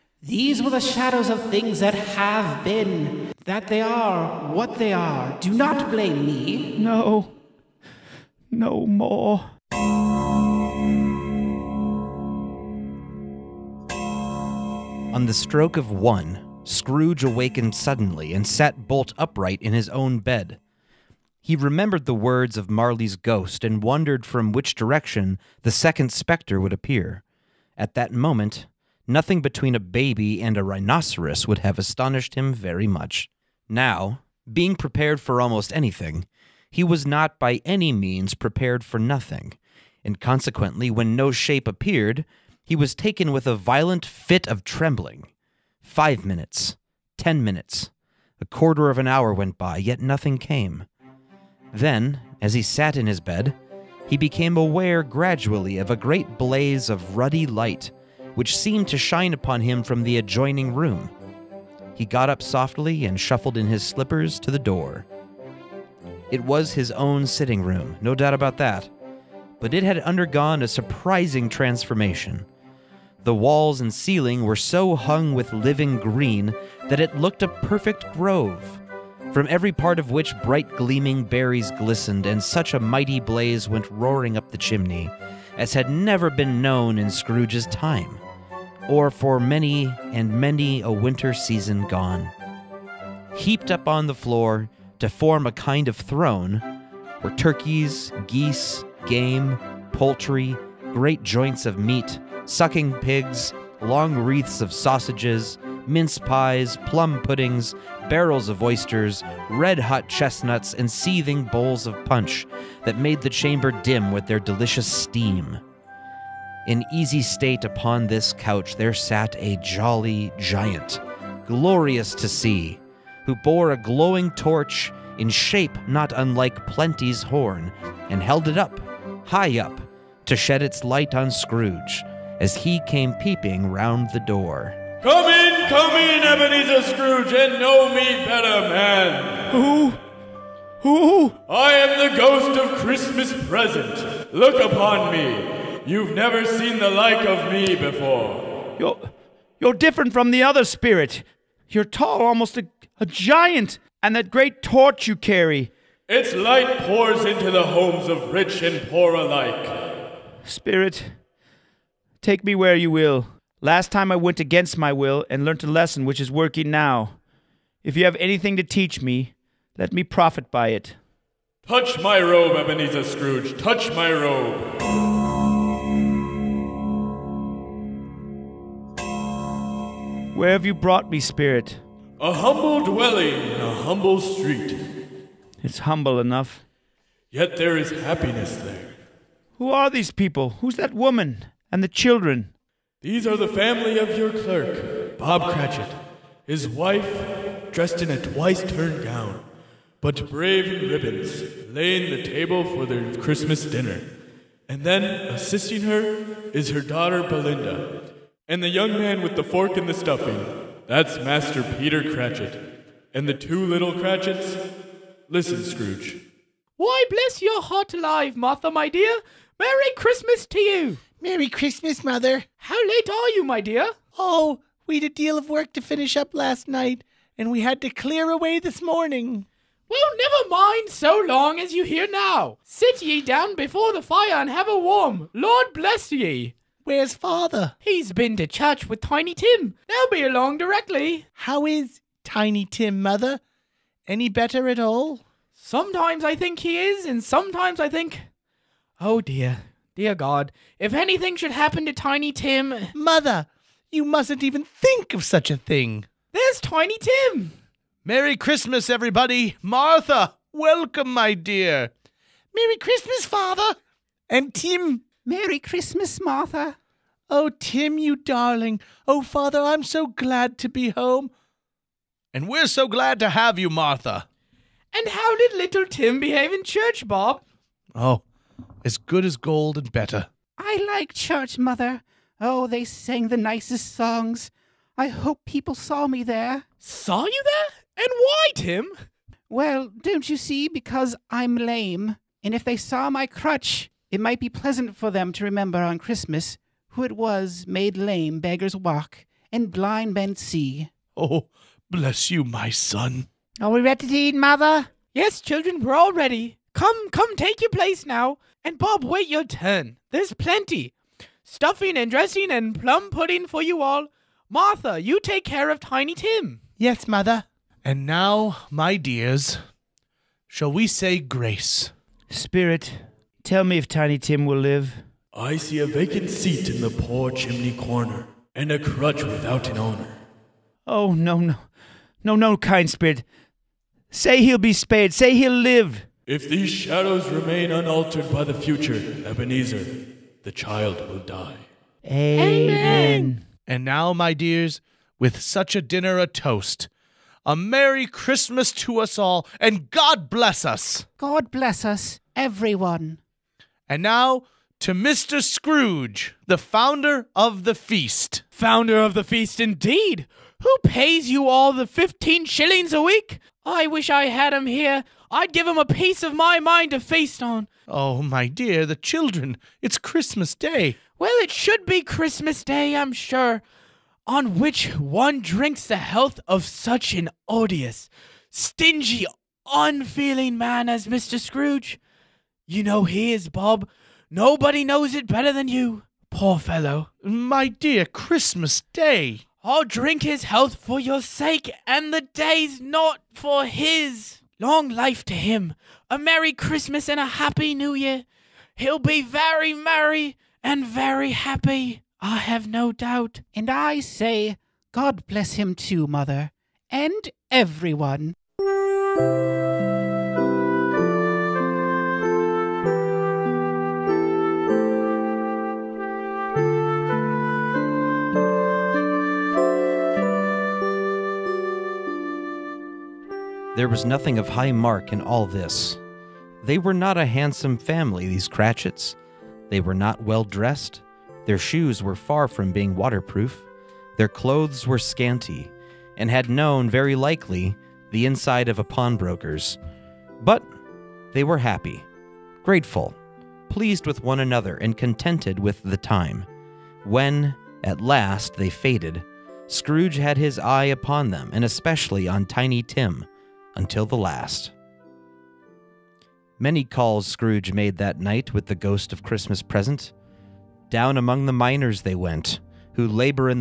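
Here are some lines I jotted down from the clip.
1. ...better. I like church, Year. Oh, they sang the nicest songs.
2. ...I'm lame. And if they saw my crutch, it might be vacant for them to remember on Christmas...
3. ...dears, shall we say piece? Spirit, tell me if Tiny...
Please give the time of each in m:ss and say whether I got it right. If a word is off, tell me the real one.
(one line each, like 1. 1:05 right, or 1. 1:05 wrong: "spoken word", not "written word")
1. 4:39 wrong: "Mother", not "Year"
2. 4:51 wrong: "pleasant", not "vacant"
3. 5:18 wrong: "grace", not "piece".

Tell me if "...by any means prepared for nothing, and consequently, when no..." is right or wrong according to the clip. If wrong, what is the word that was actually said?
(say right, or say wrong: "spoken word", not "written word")
right.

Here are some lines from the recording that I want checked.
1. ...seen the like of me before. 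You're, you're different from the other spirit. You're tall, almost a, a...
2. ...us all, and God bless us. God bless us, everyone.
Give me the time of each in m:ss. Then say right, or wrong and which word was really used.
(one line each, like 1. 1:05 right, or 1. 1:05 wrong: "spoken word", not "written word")
1. 2:26 right
2. 5:49 right.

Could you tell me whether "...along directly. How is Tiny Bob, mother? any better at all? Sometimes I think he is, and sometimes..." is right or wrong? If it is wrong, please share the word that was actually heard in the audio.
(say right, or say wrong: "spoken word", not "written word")
wrong: "Tim", not "Bob".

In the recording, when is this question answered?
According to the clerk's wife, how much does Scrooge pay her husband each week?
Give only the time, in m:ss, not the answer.
6:01.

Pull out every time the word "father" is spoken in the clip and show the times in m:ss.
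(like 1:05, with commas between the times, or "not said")
3:57, 4:23, 4:29.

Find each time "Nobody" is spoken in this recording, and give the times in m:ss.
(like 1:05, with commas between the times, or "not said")
6:24.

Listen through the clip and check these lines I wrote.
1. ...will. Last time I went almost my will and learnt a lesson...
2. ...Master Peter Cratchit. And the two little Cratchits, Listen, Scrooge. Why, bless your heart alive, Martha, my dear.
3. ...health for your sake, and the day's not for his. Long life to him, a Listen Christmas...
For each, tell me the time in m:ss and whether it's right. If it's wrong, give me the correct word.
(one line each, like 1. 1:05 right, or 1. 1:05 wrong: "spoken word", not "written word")
1. 2:42 wrong: "against", not "almost"
2. 3:31 right
3. 6:30 wrong: "Merry", not "Listen".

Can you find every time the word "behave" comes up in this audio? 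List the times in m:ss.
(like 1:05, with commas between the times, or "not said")
4:36.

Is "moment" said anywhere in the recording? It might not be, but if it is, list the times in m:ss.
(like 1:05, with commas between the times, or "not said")
0:28.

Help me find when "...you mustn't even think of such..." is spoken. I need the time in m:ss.
4:13.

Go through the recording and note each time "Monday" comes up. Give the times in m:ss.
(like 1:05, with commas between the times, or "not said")
not said.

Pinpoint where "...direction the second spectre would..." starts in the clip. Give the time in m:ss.
0:24.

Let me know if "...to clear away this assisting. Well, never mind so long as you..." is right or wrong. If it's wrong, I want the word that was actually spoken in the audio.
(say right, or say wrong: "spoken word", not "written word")
wrong: "morning", not "assisting".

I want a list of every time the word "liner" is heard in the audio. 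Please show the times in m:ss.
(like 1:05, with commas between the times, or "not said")
not said.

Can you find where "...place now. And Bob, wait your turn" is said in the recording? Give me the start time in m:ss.
5:07.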